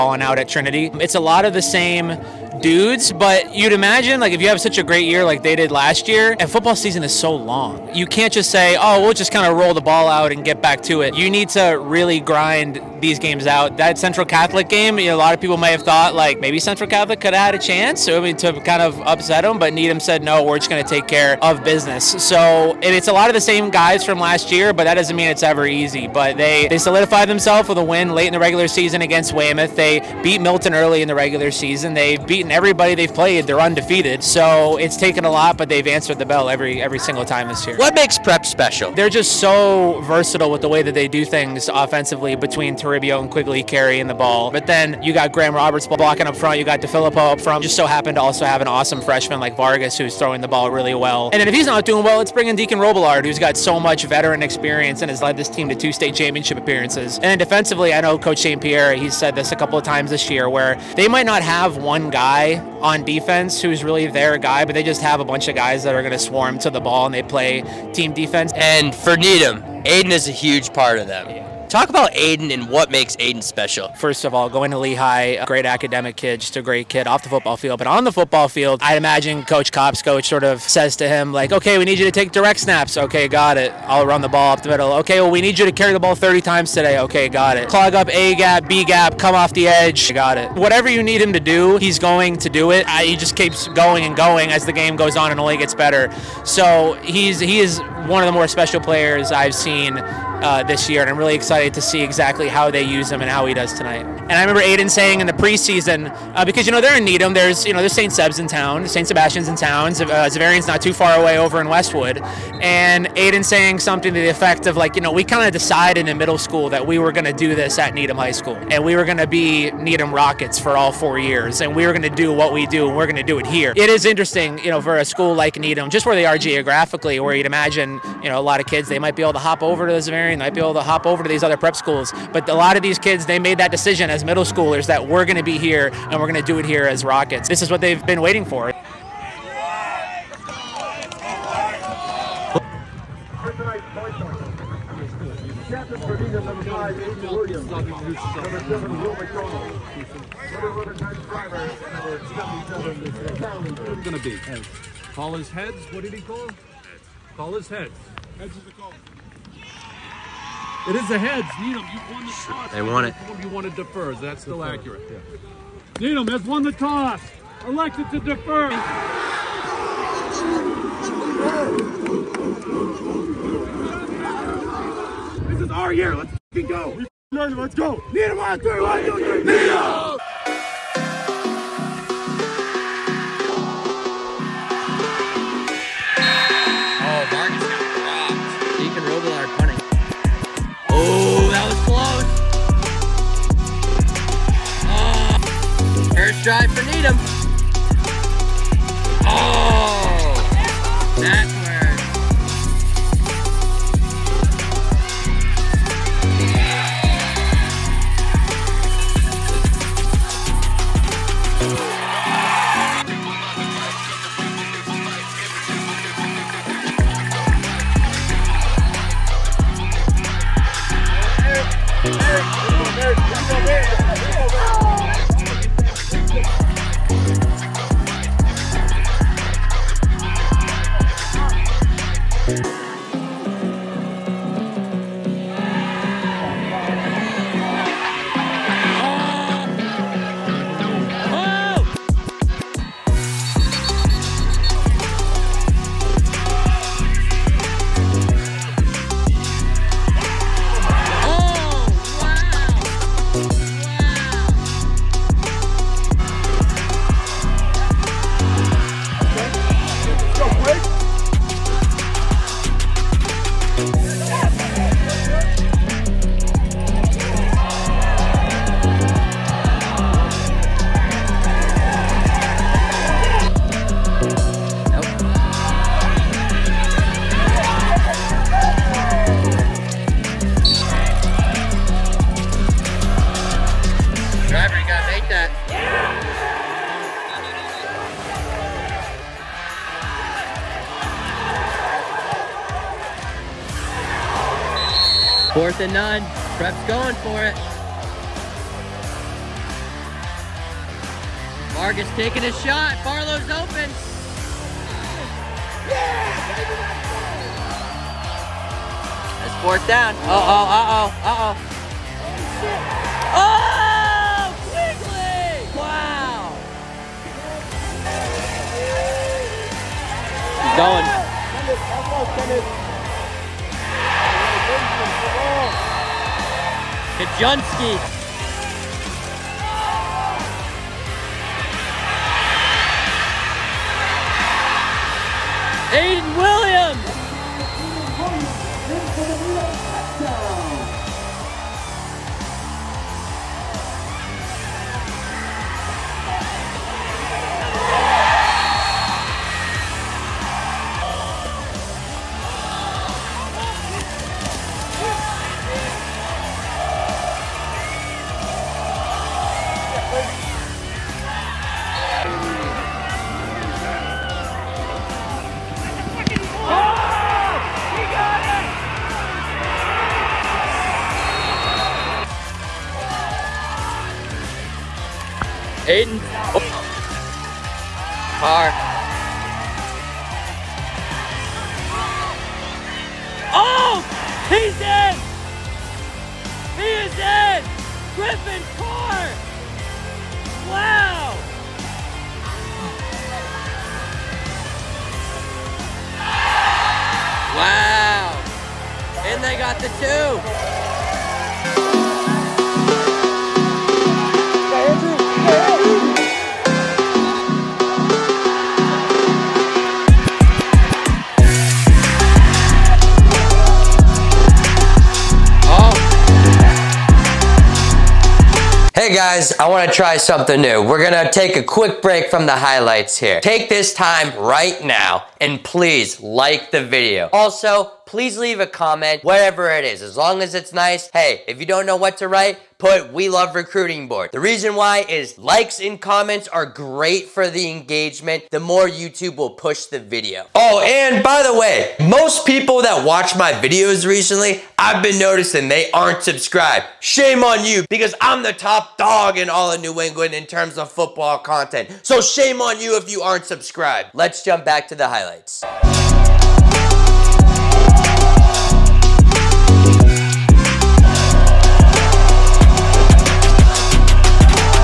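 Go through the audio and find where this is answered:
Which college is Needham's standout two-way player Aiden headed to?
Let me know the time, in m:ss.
1:14.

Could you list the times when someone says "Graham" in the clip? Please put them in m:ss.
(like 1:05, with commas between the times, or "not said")
0:45.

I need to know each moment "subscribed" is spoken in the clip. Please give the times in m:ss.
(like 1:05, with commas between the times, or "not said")
7:26, 7:33.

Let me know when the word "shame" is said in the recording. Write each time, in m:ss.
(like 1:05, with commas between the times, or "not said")
7:26, 7:32.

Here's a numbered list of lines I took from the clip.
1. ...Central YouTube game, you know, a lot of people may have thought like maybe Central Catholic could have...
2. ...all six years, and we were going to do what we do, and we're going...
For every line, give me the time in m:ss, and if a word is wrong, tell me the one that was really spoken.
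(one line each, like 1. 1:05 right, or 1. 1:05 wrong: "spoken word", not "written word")
1. 0:13 wrong: "Catholic", not "YouTube"
2. 2:00 wrong: "four", not "six".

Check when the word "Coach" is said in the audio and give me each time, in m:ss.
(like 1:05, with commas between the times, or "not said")
0:58, 1:19.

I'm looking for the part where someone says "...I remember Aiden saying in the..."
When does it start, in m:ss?
1:44.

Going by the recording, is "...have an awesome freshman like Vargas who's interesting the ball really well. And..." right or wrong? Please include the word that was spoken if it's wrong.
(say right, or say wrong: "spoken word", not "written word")
wrong: "throwing", not "interesting".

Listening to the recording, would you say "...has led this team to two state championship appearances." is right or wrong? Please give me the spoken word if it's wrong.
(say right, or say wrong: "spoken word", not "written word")
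right.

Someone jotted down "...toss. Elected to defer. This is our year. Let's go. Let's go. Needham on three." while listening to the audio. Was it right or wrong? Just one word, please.
right.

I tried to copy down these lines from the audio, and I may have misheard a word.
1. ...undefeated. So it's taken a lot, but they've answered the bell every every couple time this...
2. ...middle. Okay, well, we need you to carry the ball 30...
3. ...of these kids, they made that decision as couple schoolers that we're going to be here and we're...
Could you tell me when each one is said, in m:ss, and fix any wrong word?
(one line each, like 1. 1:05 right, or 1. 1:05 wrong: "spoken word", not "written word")
1. 0:33 wrong: "single", not "couple"
2. 1:24 right
3. 2:12 wrong: "middle", not "couple".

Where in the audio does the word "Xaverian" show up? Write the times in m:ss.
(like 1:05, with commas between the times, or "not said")
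1:50, 2:09.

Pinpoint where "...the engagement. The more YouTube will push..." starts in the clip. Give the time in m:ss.
7:17.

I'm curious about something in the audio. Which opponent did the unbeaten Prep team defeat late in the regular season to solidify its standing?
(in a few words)
Weymouth.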